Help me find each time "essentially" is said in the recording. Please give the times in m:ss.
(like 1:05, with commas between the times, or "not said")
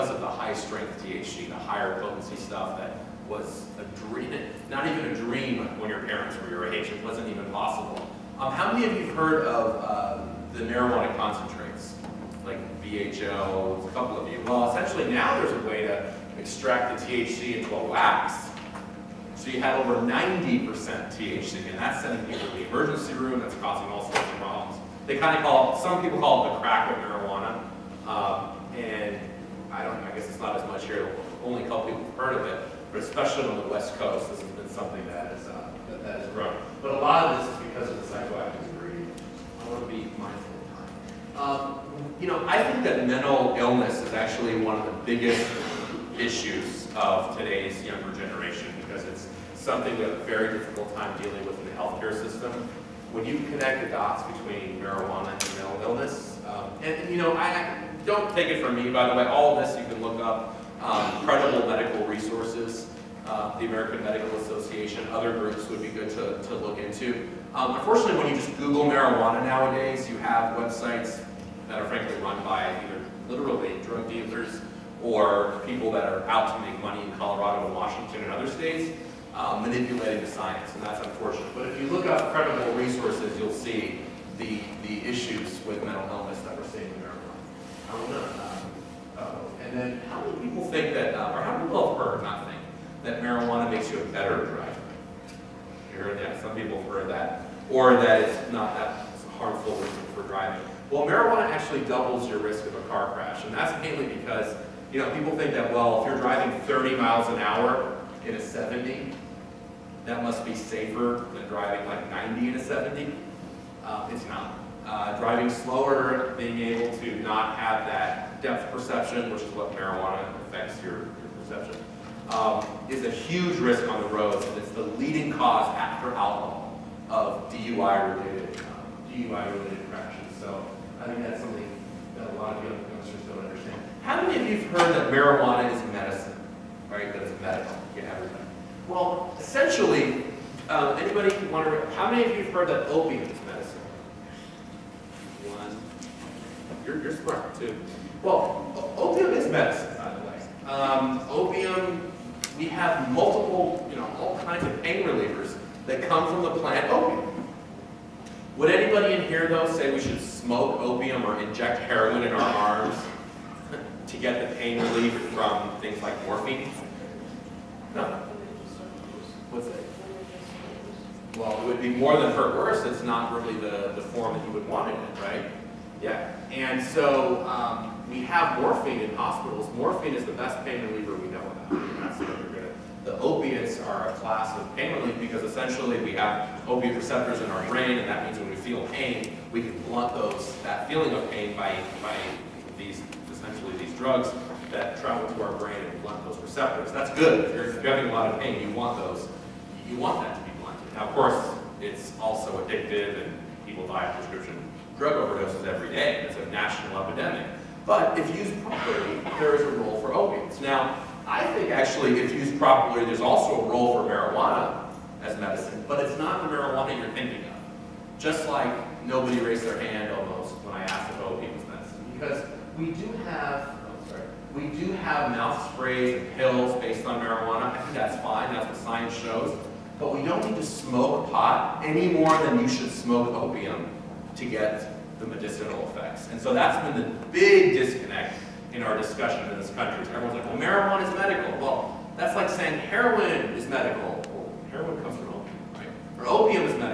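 0:14, 2:19, 3:05, 3:13.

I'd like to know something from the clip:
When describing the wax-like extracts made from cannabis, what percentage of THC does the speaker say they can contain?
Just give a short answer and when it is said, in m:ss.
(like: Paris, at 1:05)
over 90%, at 0:19.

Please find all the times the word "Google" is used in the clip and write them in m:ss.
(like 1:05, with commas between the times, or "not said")
1:08.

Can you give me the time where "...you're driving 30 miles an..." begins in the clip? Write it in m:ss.
1:46.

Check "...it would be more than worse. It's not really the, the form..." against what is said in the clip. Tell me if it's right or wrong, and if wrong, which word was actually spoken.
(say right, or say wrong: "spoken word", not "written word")
right.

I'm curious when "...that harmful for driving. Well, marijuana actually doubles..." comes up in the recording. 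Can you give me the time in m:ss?
1:38.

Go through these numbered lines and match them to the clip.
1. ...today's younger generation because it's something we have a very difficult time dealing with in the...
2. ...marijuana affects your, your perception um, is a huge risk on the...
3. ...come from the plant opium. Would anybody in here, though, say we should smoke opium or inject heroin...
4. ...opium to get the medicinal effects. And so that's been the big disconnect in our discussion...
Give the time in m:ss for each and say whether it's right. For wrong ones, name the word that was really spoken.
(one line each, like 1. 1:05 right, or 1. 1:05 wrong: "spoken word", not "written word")
1. 0:47 right
2. 1:59 right
3. 2:36 right
4. 3:53 right.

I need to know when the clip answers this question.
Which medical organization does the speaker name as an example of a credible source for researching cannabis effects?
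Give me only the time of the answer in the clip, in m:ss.
1:03.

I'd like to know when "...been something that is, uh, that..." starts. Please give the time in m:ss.
0:34.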